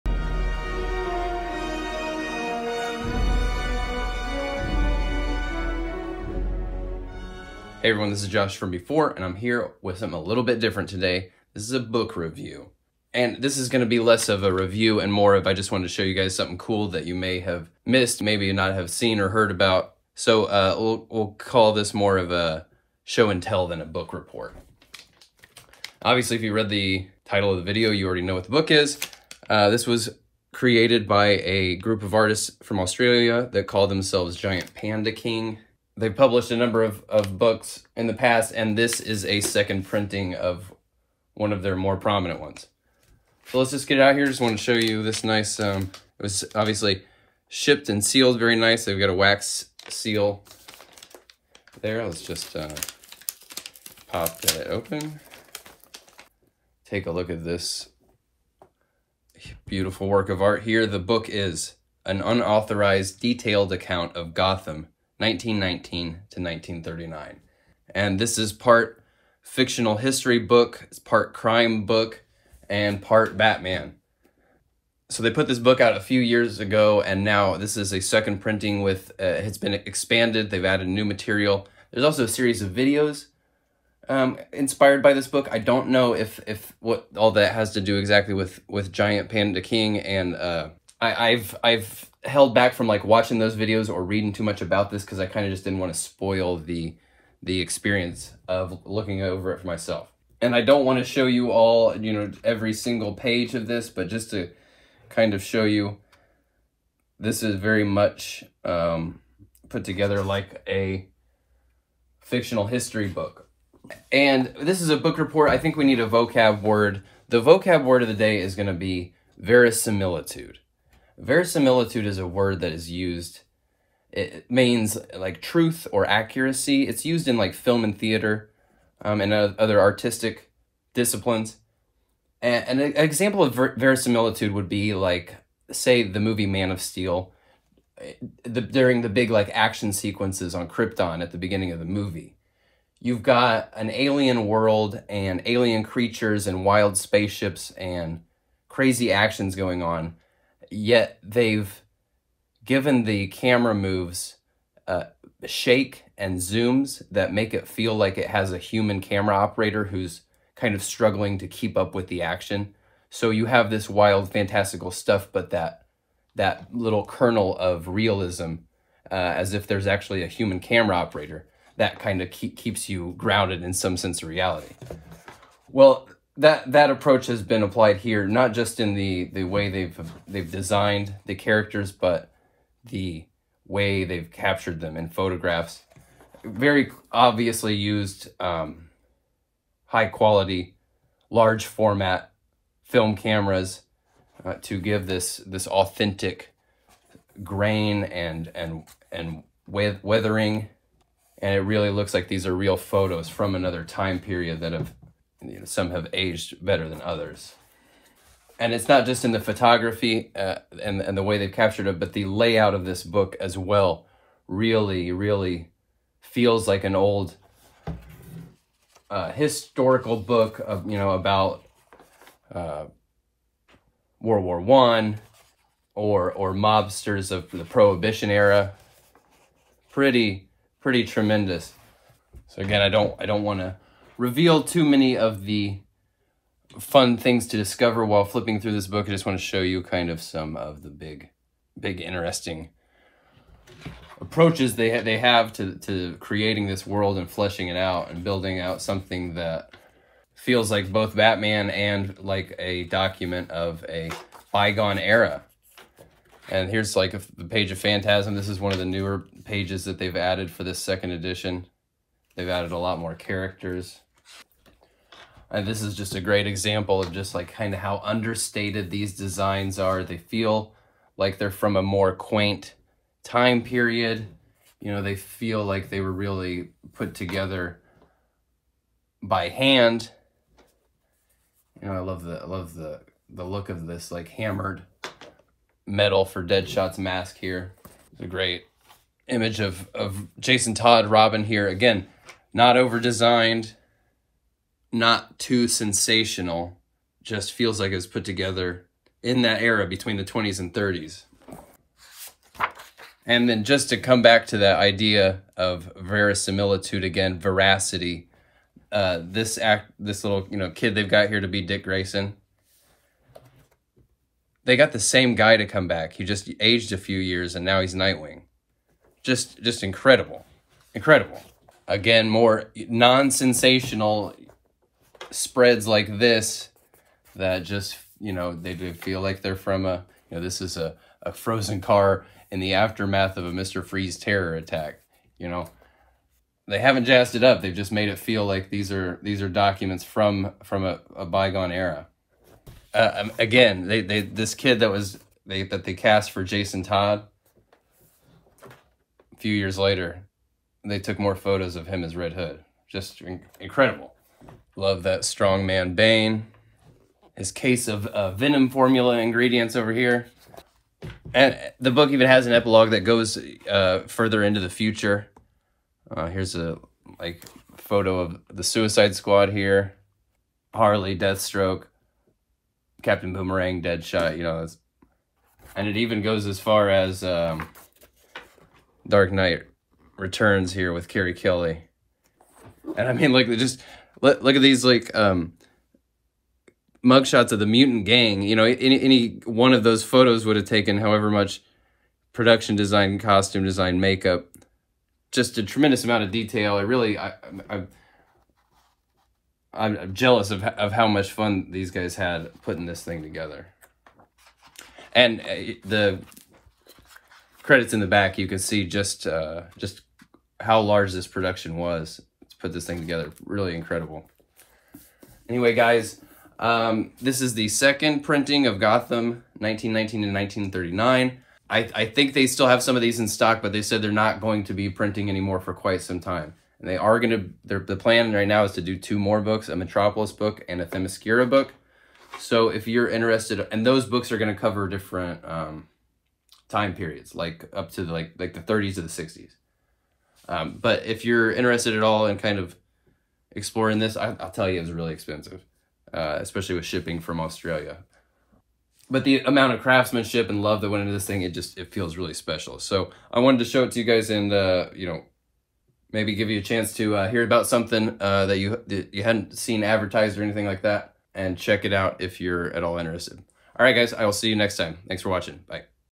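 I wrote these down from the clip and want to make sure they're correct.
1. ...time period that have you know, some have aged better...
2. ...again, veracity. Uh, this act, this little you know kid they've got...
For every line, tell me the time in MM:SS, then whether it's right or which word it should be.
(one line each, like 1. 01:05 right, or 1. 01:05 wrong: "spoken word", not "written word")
1. 03:23 right
2. 05:07 right.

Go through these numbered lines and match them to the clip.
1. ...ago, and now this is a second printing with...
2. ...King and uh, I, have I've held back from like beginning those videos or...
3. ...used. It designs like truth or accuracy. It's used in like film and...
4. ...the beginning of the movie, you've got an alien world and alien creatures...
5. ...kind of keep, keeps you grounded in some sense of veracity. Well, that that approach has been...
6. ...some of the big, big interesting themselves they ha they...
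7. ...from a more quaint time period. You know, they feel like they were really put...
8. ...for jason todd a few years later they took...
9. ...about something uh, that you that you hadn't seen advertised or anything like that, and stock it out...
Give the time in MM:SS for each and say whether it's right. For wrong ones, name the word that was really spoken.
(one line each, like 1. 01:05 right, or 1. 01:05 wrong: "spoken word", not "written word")
1. 01:16 right
2. 01:29 wrong: "watching", not "beginning"
3. 02:02 wrong: "means", not "designs"
4. 02:21 right
5. 02:51 wrong: "reality", not "veracity"
6. 04:00 wrong: "approaches", not "themselves"
7. 04:31 right
8. 05:46 right
9. 07:37 wrong: "check", not "stock".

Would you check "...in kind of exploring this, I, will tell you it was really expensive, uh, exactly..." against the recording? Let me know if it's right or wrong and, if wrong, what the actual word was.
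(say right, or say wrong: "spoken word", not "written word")
wrong: "especially", not "exactly".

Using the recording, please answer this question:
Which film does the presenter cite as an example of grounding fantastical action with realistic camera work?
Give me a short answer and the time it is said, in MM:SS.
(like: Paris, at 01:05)
Man of Steel, at 02:16.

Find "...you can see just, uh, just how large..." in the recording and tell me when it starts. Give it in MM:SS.
06:48.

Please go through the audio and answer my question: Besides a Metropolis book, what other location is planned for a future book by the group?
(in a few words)
Themyscira.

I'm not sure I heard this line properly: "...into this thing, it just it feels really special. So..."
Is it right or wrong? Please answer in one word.
right.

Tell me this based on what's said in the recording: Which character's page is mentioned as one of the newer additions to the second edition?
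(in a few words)
Phantasm.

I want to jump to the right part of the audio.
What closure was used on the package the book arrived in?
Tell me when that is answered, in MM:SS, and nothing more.
00:49.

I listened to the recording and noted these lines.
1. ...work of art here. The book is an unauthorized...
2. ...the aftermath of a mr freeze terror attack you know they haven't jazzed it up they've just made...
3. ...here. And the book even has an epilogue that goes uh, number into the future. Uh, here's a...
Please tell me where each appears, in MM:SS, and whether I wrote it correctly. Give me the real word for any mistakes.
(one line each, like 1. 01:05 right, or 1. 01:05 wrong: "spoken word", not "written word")
1. 01:00 right
2. 05:32 right
3. 05:59 wrong: "further", not "number".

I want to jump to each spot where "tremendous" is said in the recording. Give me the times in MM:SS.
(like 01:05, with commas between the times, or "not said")
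03:51, 06:35.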